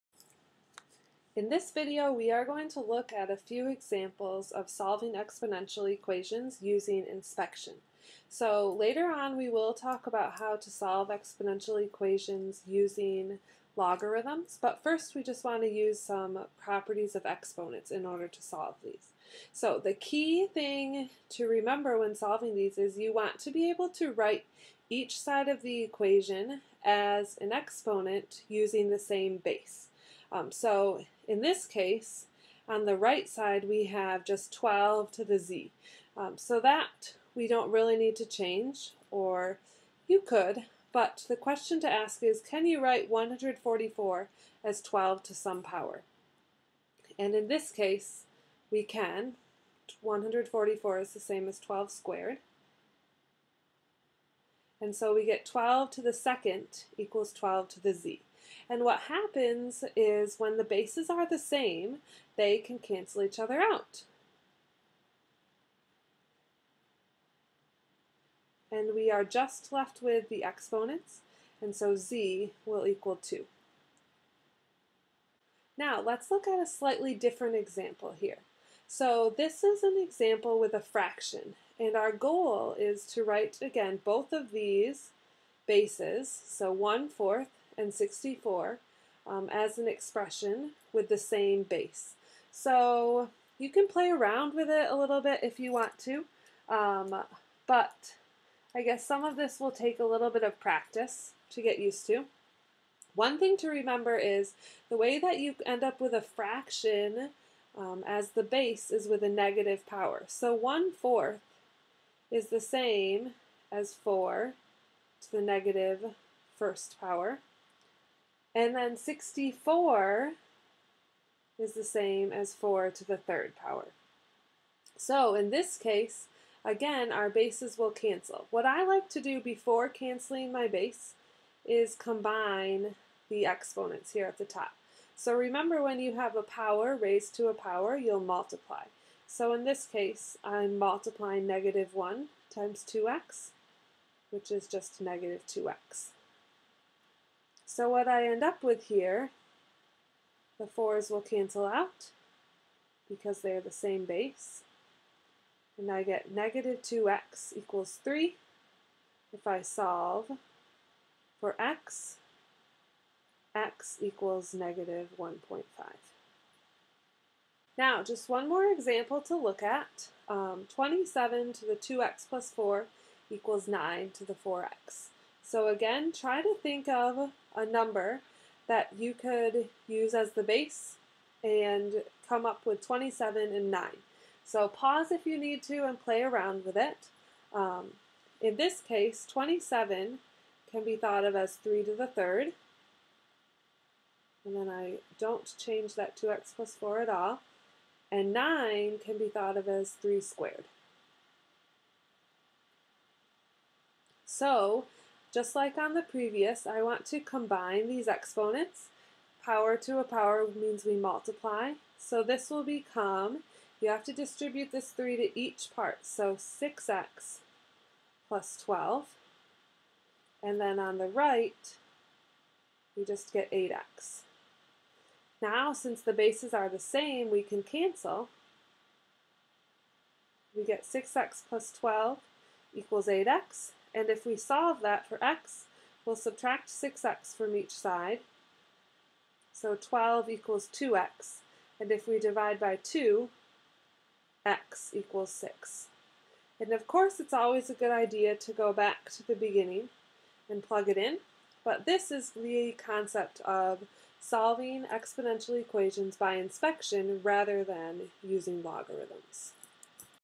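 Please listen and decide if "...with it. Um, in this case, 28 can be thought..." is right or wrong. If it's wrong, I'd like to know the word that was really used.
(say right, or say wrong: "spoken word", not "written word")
wrong: "27", not "28".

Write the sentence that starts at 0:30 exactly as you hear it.
Um, so in this case, on the right side, we have just 12 to the z.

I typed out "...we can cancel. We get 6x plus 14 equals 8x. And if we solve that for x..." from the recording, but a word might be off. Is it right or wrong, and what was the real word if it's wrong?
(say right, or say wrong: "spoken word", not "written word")
wrong: "12", not "14".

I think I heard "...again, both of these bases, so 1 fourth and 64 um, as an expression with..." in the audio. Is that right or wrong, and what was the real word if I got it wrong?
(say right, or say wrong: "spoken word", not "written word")
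right.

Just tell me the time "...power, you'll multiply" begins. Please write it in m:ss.
2:17.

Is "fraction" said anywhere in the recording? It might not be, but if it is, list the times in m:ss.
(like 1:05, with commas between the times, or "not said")
1:20, 1:46.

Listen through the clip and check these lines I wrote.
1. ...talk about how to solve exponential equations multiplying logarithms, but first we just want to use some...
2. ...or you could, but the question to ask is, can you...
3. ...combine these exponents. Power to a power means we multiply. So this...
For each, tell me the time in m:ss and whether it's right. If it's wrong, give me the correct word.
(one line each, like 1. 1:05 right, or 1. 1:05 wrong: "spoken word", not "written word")
1. 0:09 wrong: "using", not "multiplying"
2. 0:39 right
3. 3:27 right.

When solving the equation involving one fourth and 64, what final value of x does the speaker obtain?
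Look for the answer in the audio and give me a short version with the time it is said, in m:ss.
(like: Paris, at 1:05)
-1.5, at 2:43.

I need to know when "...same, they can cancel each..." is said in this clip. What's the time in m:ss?
1:01.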